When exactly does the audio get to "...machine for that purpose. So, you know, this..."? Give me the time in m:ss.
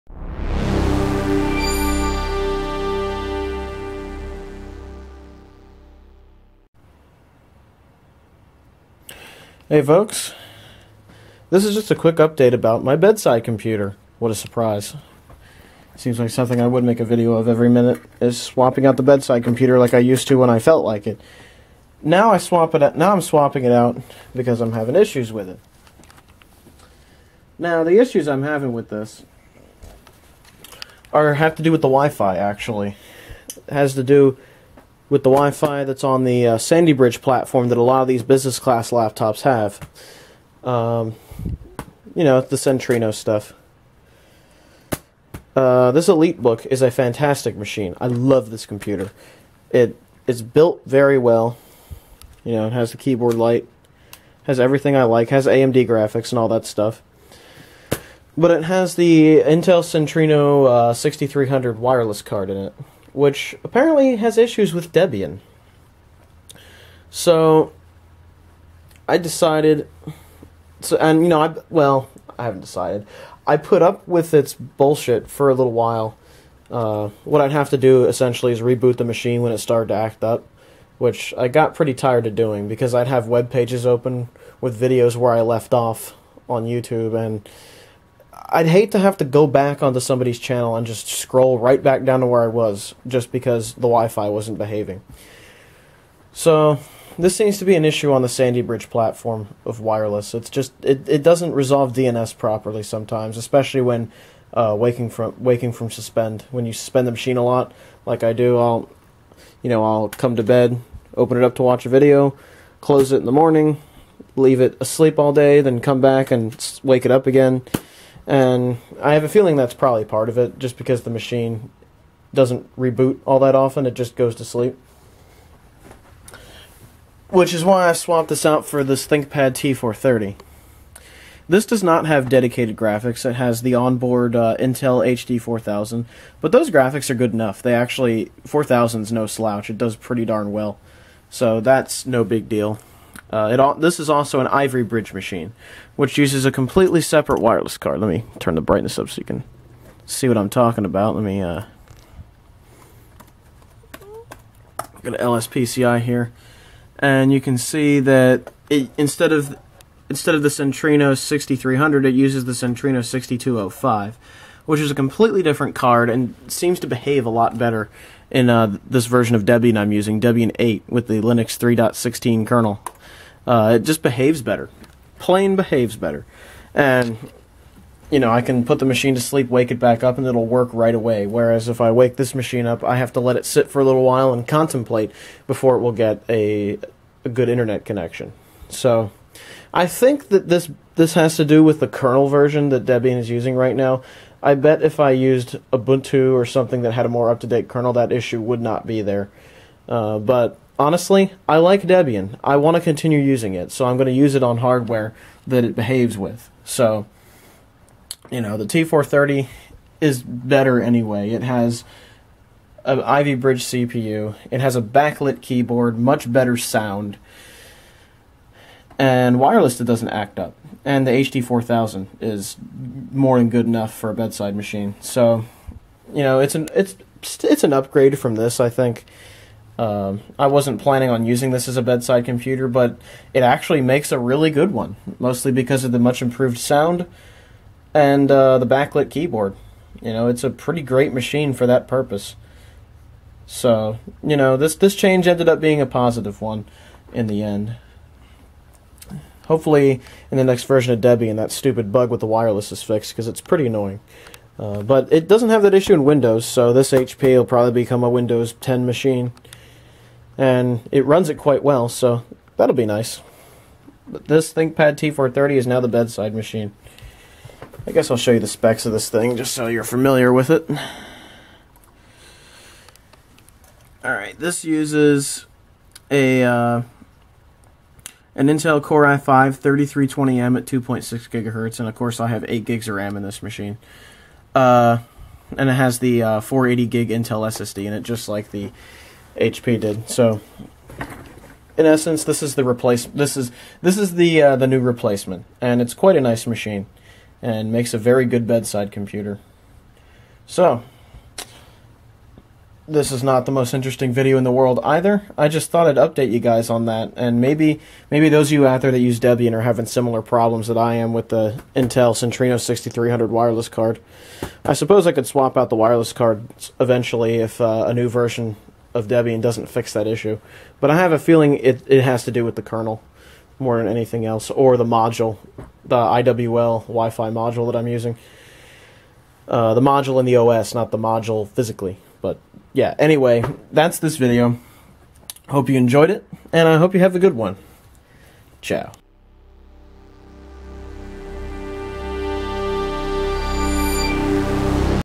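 4:01.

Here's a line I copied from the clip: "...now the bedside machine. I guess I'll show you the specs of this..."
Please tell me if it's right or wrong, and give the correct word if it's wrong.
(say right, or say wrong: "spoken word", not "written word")
right.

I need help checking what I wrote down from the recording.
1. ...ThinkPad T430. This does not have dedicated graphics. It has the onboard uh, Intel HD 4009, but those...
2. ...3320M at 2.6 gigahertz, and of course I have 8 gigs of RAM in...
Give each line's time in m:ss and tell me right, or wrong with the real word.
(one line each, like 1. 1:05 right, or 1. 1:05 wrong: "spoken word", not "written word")
1. 2:09 wrong: "4000", not "4009"
2. 4:39 right.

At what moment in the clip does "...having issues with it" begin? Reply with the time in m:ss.
0:24.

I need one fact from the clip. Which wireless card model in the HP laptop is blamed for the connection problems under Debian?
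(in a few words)
Centrino 6300.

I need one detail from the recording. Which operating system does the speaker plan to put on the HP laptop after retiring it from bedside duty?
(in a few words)
Windows 10.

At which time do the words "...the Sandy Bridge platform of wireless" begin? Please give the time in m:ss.
1:38.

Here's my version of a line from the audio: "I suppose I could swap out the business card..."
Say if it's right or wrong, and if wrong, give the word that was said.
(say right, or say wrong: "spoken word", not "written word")
wrong: "wireless", not "business".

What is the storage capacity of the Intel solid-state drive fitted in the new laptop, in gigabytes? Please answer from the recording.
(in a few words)
480.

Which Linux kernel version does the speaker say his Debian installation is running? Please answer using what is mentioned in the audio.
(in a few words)
3.16.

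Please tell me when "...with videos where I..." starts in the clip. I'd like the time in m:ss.
1:24.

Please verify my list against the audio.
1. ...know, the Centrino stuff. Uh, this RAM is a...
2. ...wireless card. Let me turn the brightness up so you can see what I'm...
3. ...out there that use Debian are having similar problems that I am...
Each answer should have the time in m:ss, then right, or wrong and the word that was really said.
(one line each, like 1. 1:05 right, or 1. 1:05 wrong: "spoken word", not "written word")
1. 0:42 wrong: "EliteBook", not "RAM"
2. 2:27 right
3. 5:08 right.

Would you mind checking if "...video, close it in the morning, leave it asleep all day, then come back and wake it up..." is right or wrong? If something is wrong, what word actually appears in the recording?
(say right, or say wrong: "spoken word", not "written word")
right.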